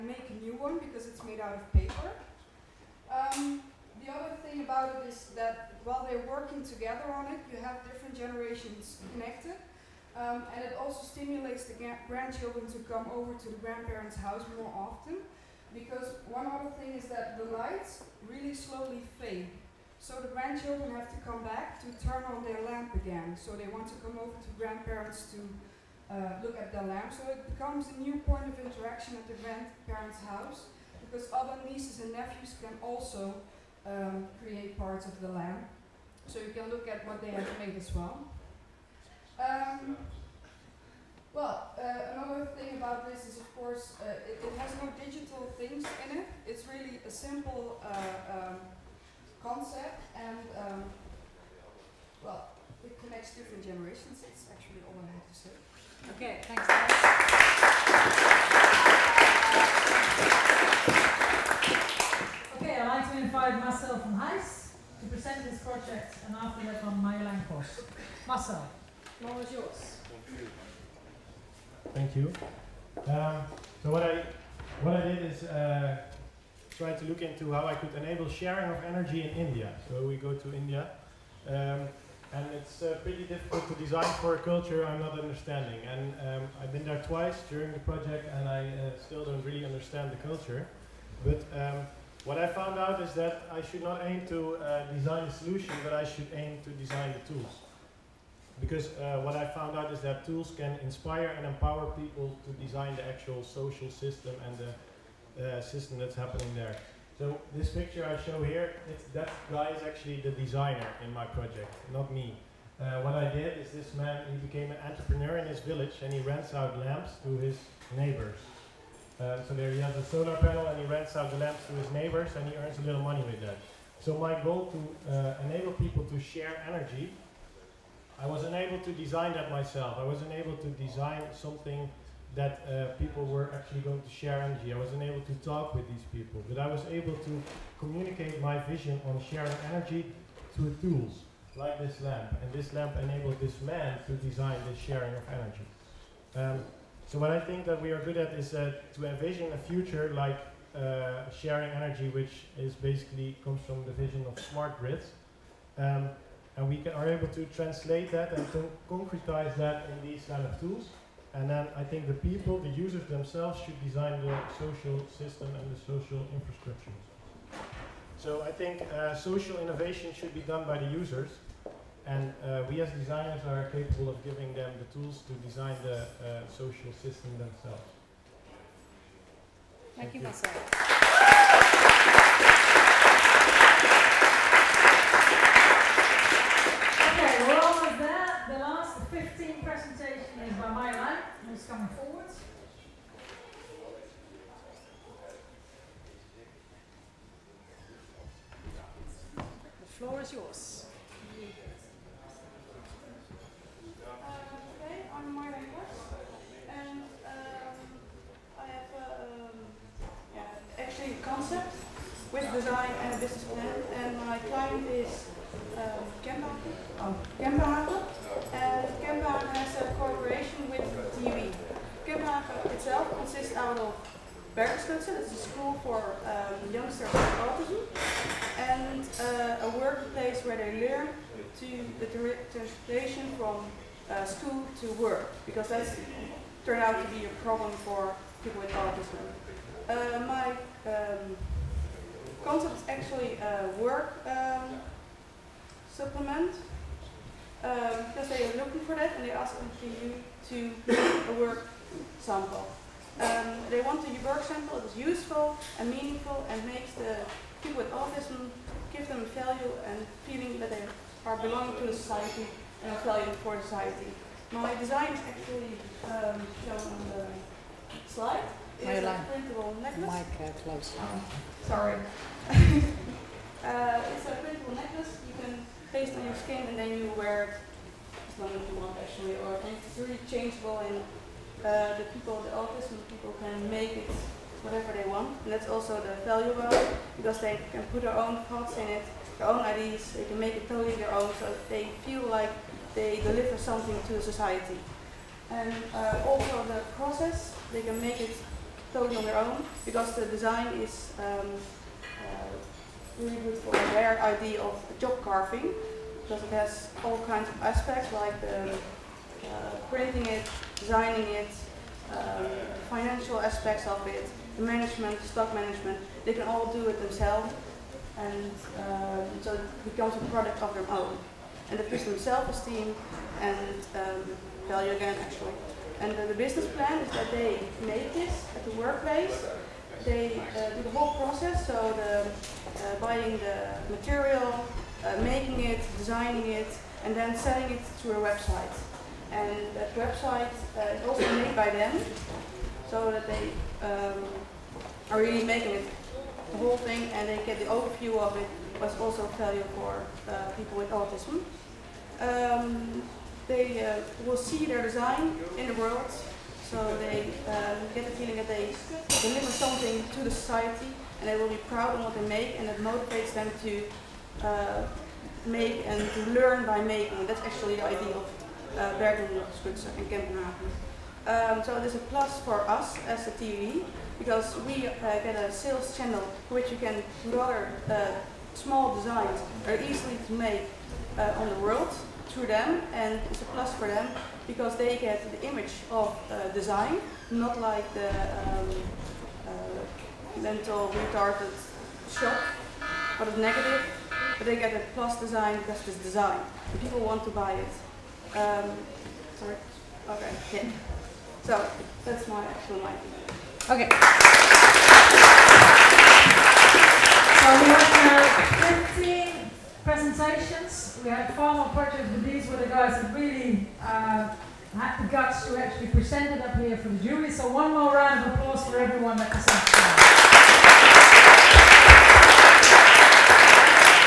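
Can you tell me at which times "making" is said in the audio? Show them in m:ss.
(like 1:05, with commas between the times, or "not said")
5:35, 5:45, 6:06.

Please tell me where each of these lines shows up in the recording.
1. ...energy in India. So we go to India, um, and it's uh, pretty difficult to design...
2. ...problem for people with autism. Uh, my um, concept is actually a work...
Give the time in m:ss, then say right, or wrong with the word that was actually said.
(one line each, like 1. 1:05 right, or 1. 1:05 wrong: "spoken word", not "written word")
1. 1:18 right
2. 3:57 right.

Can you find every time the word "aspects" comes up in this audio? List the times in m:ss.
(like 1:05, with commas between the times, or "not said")
5:07, 5:13.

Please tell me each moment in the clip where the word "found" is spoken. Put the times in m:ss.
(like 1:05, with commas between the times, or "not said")
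1:32, 1:39.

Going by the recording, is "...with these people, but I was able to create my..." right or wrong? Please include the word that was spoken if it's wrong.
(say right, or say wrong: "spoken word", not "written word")
wrong: "communicate", not "create".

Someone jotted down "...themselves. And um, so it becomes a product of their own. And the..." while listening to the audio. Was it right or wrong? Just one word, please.
right.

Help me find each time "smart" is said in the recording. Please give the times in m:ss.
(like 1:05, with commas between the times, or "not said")
2:34.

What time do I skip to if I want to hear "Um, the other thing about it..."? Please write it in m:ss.
0:03.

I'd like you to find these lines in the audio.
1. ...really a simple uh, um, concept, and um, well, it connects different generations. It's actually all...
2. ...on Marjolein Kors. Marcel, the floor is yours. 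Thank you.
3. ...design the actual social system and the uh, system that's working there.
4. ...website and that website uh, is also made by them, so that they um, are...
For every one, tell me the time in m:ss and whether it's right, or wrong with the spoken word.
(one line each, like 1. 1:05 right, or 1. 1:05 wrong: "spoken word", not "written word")
1. 0:46 right
2. 1:06 right
3. 1:42 wrong: "happening", not "working"
4. 5:38 right.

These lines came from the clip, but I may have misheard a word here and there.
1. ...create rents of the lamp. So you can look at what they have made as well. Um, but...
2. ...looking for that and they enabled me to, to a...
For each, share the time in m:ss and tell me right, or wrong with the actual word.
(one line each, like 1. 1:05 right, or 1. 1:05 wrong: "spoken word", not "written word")
1. 0:34 wrong: "parts", not "rents"
2. 4:08 wrong: "asked", not "enabled".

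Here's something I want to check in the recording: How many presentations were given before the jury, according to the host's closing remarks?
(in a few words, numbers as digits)
15.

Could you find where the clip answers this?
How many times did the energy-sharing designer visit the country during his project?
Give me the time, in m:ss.
1:27.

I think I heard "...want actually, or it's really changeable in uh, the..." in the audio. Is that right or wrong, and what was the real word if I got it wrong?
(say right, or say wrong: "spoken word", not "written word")
right.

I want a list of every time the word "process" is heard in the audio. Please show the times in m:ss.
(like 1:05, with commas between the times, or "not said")
4:56, 5:31.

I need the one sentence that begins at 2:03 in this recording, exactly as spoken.
So my goal to uh, enable people to share energy I wasn't able to design that myself.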